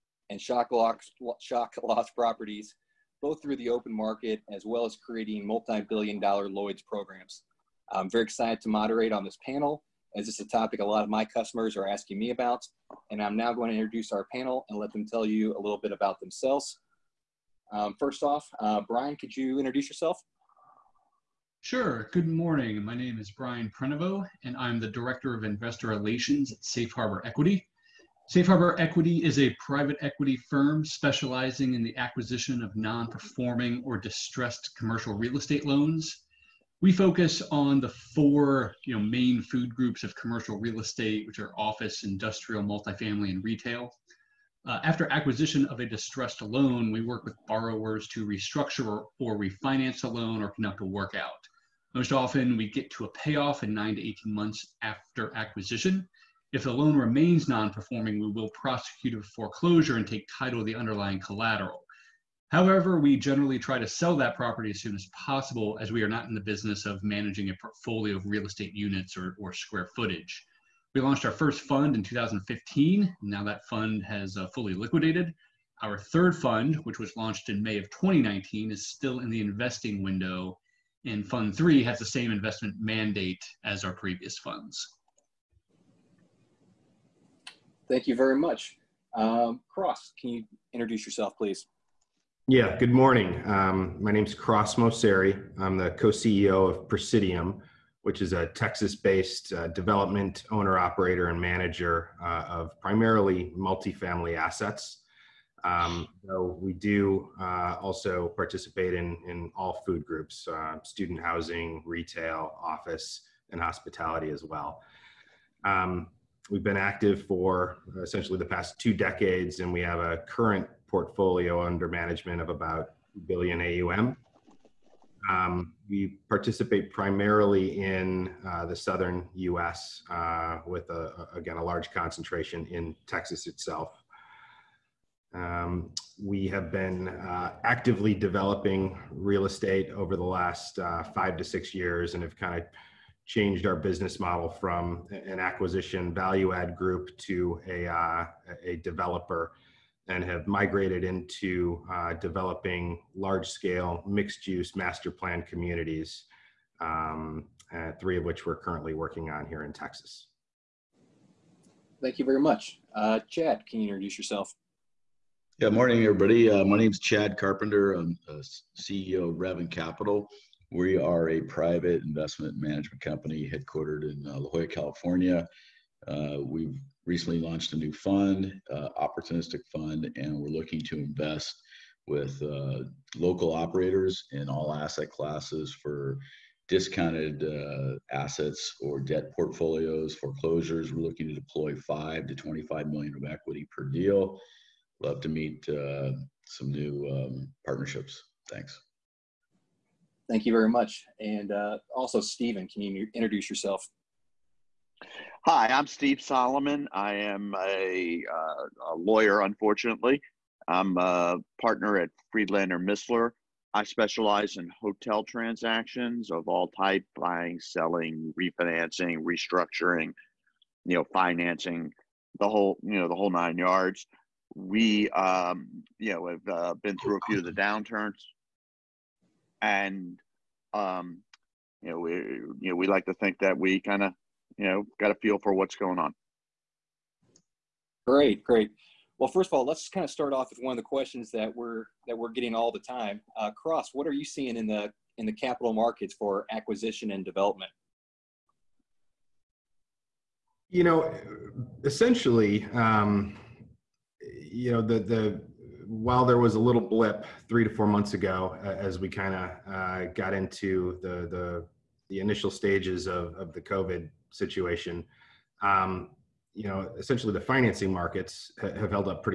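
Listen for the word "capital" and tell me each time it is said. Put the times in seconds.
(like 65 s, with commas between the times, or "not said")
169 s, 245 s.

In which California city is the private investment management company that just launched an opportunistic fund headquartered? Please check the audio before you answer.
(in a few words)
La Jolla.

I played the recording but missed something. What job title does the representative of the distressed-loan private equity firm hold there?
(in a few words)
Director of Investor Relations.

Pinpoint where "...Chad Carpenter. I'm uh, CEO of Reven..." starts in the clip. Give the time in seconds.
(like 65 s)
166 s.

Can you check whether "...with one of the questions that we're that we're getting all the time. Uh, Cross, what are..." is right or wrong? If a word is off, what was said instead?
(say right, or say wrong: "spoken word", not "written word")
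right.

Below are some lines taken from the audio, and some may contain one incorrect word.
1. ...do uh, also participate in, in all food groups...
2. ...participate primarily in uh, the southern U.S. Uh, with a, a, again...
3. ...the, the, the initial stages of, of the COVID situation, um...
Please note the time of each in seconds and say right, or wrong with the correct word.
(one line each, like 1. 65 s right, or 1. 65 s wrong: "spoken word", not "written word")
1. 106 s right
2. 126 s right
3. 261 s right.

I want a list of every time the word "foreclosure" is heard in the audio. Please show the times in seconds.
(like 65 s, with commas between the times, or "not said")
59 s, 190 s.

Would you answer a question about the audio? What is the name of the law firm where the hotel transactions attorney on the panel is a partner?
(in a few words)
Friedlander Misler.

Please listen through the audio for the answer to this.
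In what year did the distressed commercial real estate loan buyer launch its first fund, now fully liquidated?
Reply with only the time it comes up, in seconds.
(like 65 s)
72 s.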